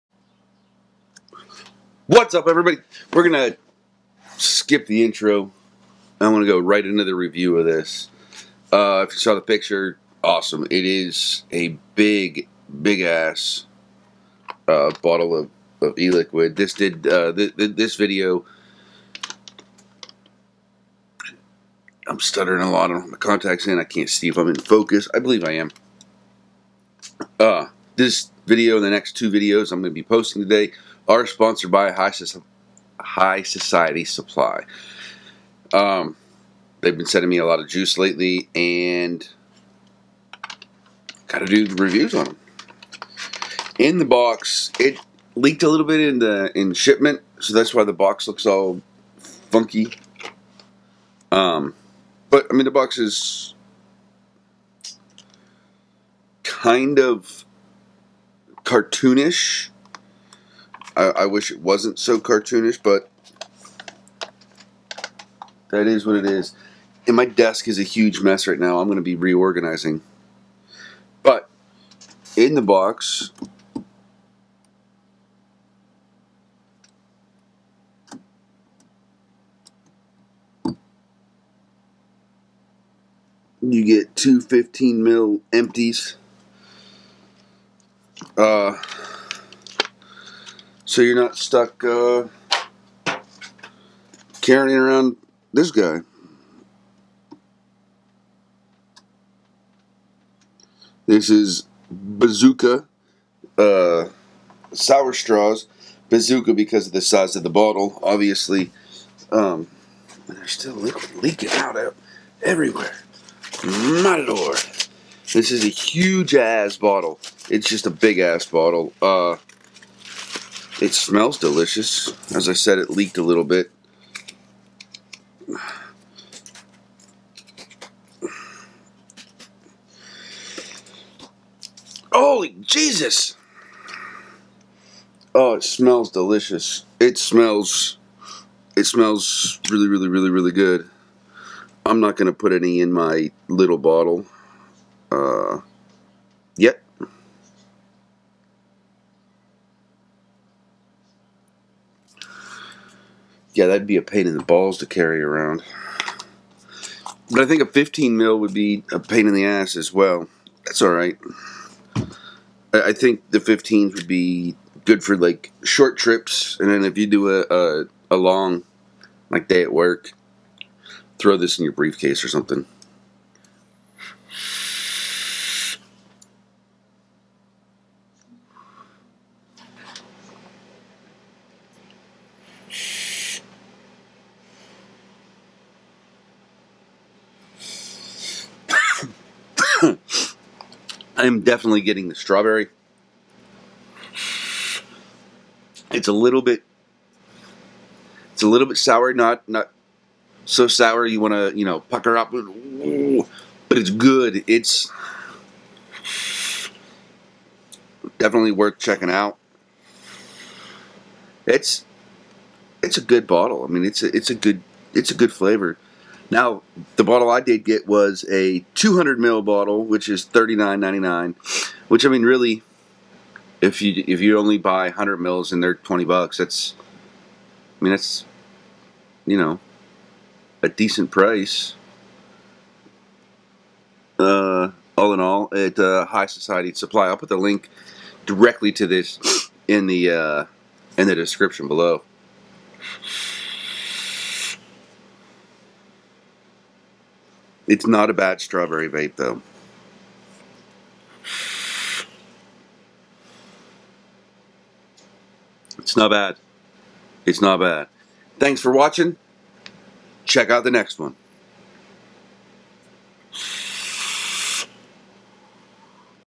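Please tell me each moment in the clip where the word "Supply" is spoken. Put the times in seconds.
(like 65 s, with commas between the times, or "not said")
34 s, 236 s.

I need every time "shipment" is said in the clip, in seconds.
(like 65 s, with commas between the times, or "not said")
46 s.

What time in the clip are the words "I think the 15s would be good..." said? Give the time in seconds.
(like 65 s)
162 s.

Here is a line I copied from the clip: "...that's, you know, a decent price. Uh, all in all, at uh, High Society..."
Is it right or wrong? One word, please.
right.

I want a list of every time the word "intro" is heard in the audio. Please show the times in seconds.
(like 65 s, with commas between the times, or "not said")
5 s.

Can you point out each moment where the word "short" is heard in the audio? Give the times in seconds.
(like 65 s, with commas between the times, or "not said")
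165 s.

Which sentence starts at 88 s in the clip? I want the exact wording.
Uh, so you're not stuck uh, carrying around this guy.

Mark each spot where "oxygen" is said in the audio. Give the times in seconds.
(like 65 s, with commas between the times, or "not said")
not said.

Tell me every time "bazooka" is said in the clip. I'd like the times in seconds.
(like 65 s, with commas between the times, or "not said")
101 s, 106 s.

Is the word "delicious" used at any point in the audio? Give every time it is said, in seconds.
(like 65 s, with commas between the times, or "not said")
121 s, 136 s.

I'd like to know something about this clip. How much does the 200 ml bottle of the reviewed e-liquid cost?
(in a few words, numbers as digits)
$39.99.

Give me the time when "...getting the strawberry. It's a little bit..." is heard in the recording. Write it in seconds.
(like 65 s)
191 s.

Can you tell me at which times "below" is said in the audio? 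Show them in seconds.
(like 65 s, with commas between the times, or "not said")
241 s.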